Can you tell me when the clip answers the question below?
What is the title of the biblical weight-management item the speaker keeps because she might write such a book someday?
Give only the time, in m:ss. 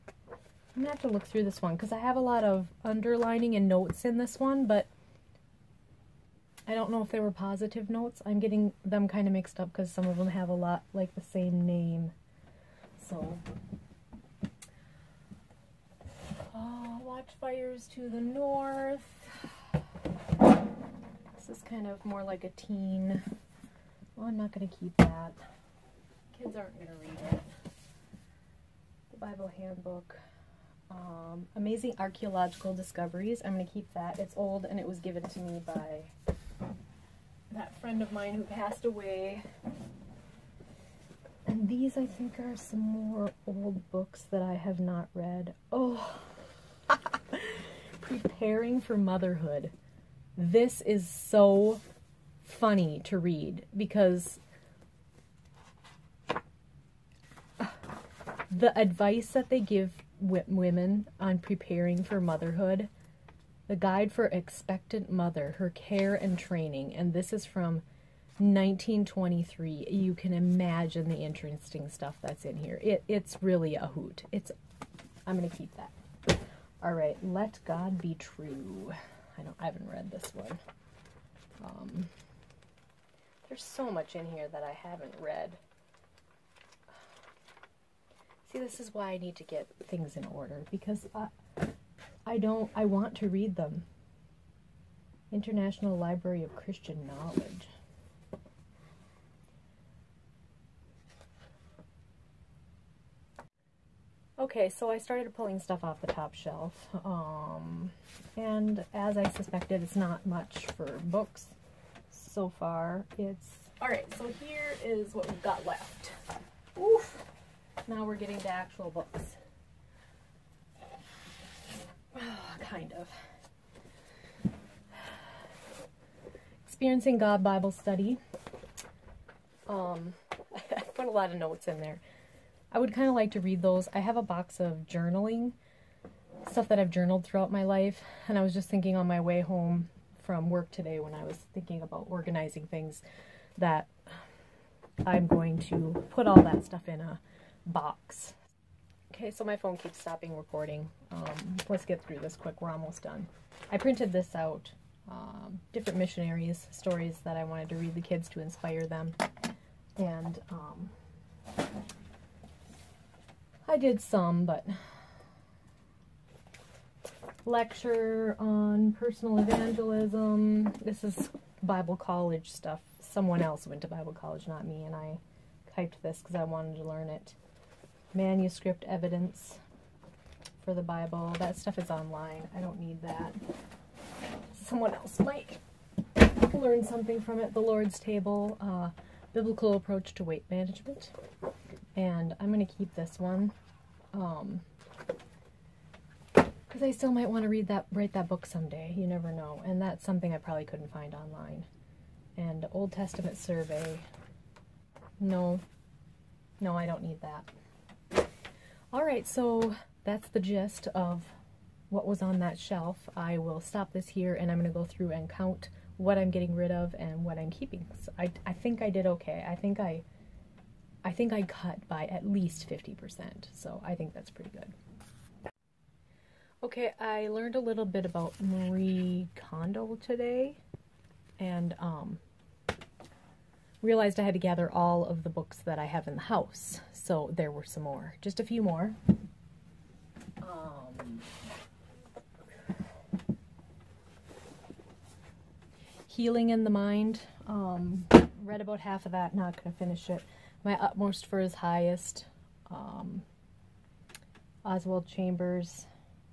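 3:07.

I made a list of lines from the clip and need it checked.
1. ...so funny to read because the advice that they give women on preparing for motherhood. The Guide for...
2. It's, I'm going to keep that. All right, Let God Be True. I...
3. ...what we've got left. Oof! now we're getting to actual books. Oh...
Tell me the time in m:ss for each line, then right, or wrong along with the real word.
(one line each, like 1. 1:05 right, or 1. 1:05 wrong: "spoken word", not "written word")
1. 0:51 right
2. 1:14 right
3. 1:55 right.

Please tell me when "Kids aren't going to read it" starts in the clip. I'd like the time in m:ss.
0:26.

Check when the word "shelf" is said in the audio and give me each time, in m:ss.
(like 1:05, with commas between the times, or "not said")
1:46, 3:32.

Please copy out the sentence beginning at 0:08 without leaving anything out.
I'm getting them kind of mixed up because some of them have a lot like the same name.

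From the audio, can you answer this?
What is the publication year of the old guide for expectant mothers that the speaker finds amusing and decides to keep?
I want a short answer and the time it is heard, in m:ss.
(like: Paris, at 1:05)
1923, at 1:08.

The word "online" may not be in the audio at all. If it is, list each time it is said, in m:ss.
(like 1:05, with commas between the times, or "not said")
3:01, 3:21.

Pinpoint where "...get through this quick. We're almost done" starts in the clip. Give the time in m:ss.
2:31.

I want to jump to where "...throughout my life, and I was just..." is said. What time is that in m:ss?
2:17.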